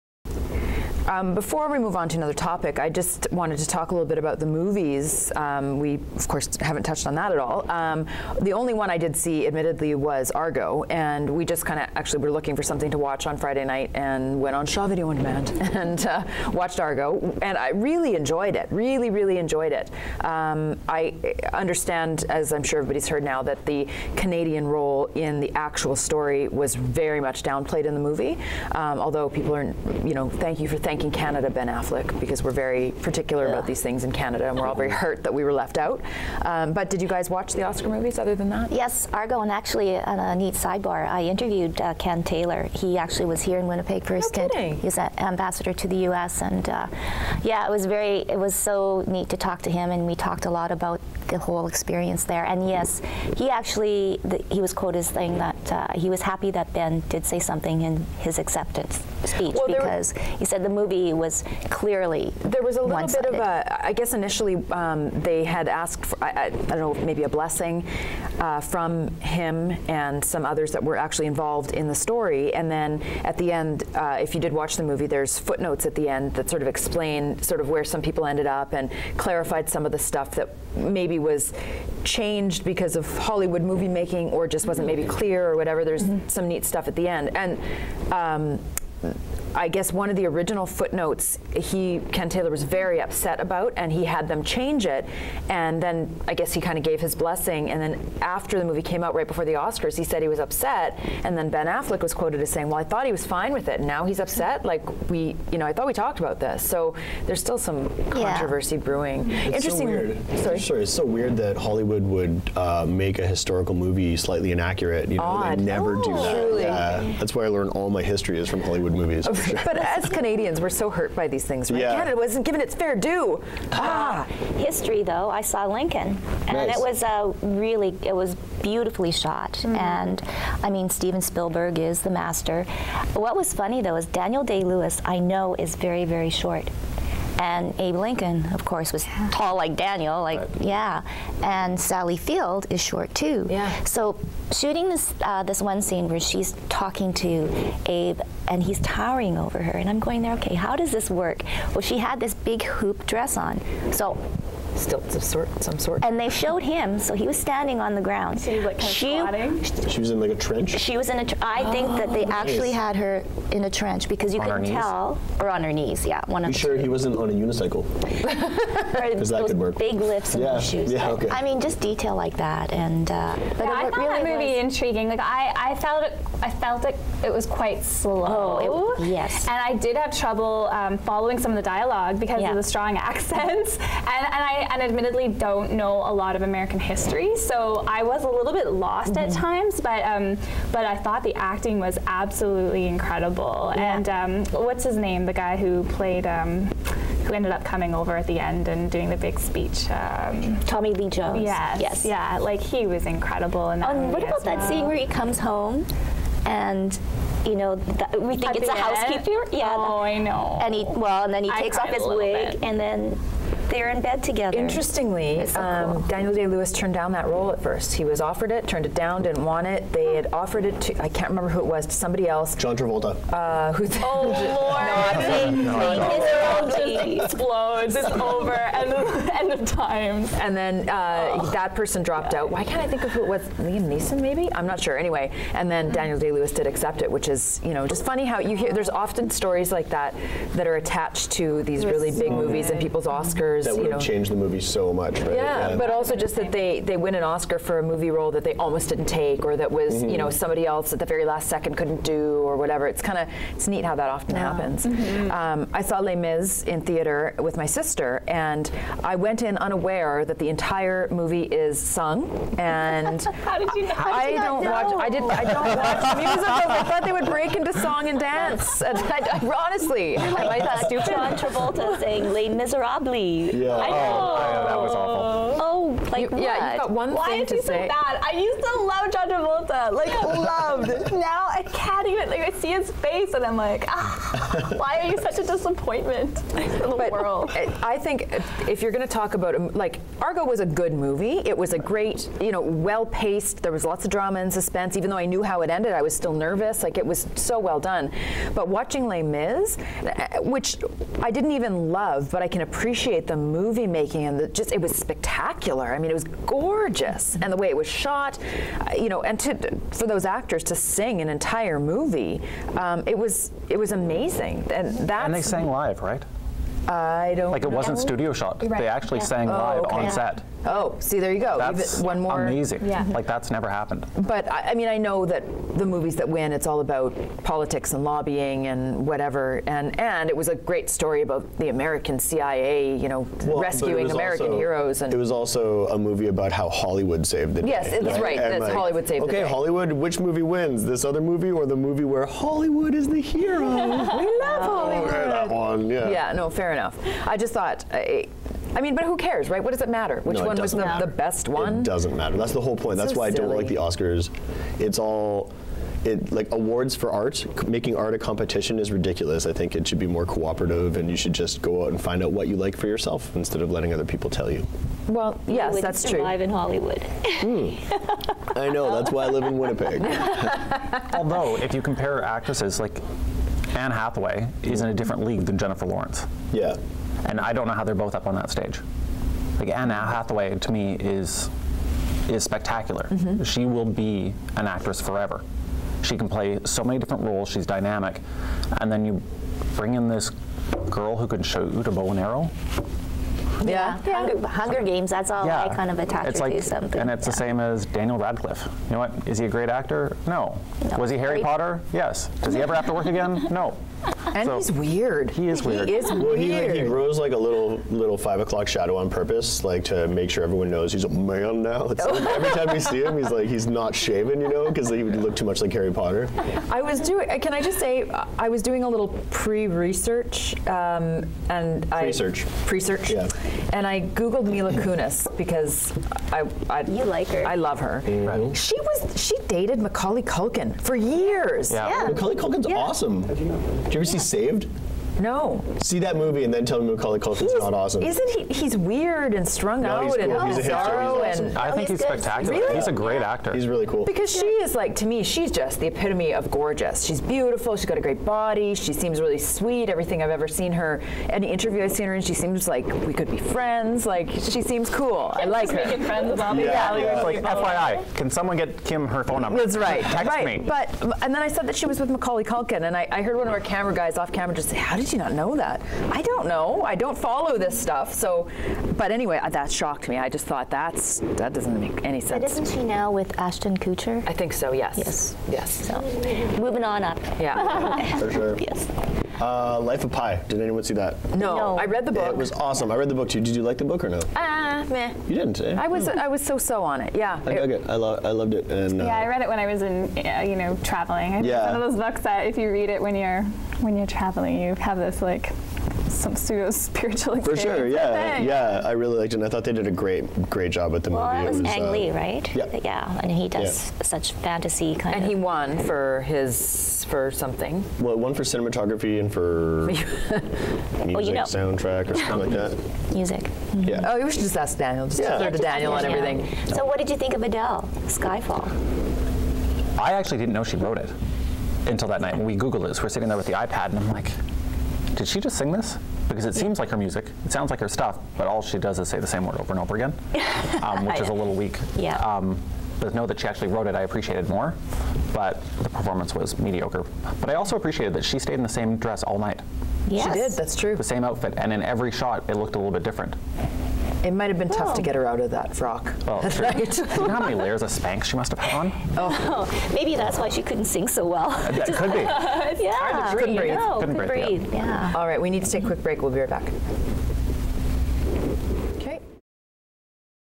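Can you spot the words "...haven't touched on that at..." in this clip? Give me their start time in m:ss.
0:06.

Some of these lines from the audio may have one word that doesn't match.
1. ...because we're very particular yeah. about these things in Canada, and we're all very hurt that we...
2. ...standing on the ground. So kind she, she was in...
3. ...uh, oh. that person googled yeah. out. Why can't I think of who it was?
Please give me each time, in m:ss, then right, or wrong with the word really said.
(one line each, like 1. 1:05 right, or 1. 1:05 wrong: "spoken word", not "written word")
1. 0:32 right
2. 2:37 right
3. 3:50 wrong: "dropped", not "googled".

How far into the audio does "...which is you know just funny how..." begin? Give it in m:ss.
3:57.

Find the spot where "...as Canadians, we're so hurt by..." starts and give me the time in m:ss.
1:59.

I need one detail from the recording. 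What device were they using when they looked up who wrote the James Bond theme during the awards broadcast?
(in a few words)
iPad.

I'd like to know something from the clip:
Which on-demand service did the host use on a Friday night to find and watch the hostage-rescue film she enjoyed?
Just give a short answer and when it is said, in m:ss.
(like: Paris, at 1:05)
Shaw Video on Demand, at 0:14.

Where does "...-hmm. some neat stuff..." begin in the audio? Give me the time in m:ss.
1:26.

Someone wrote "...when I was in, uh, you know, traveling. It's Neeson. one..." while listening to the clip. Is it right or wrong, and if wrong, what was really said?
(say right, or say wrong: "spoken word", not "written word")
wrong: "Yeah", not "Neeson".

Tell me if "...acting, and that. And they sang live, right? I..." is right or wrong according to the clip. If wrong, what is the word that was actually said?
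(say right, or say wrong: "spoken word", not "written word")
wrong: "amazing", not "acting".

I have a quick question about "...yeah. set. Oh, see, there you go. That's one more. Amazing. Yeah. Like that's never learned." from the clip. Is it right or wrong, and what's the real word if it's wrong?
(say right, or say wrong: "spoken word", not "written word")
wrong: "happened", not "learned".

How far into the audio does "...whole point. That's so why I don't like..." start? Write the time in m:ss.
5:52.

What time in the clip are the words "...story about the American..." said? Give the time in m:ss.
5:30.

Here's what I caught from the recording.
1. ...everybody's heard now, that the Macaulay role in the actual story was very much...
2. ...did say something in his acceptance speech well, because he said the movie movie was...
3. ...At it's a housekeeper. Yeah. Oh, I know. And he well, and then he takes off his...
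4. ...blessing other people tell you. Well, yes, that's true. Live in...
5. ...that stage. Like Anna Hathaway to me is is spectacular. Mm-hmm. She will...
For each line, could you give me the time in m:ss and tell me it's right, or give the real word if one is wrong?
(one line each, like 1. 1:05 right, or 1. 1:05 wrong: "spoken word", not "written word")
1. 0:22 wrong: "Canadian", not "Macaulay"
2. 0:57 right
3. 3:28 right
4. 6:03 wrong: "letting", not "blessing"
5. 6:18 right.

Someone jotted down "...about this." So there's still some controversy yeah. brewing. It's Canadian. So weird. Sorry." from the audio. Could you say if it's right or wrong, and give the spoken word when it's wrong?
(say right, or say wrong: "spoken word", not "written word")
wrong: "Interesting", not "Canadian".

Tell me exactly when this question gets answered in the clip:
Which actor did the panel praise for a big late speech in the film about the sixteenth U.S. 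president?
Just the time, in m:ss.
3:20.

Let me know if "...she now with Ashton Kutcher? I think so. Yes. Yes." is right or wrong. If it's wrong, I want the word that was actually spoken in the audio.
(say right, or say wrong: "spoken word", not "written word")
right.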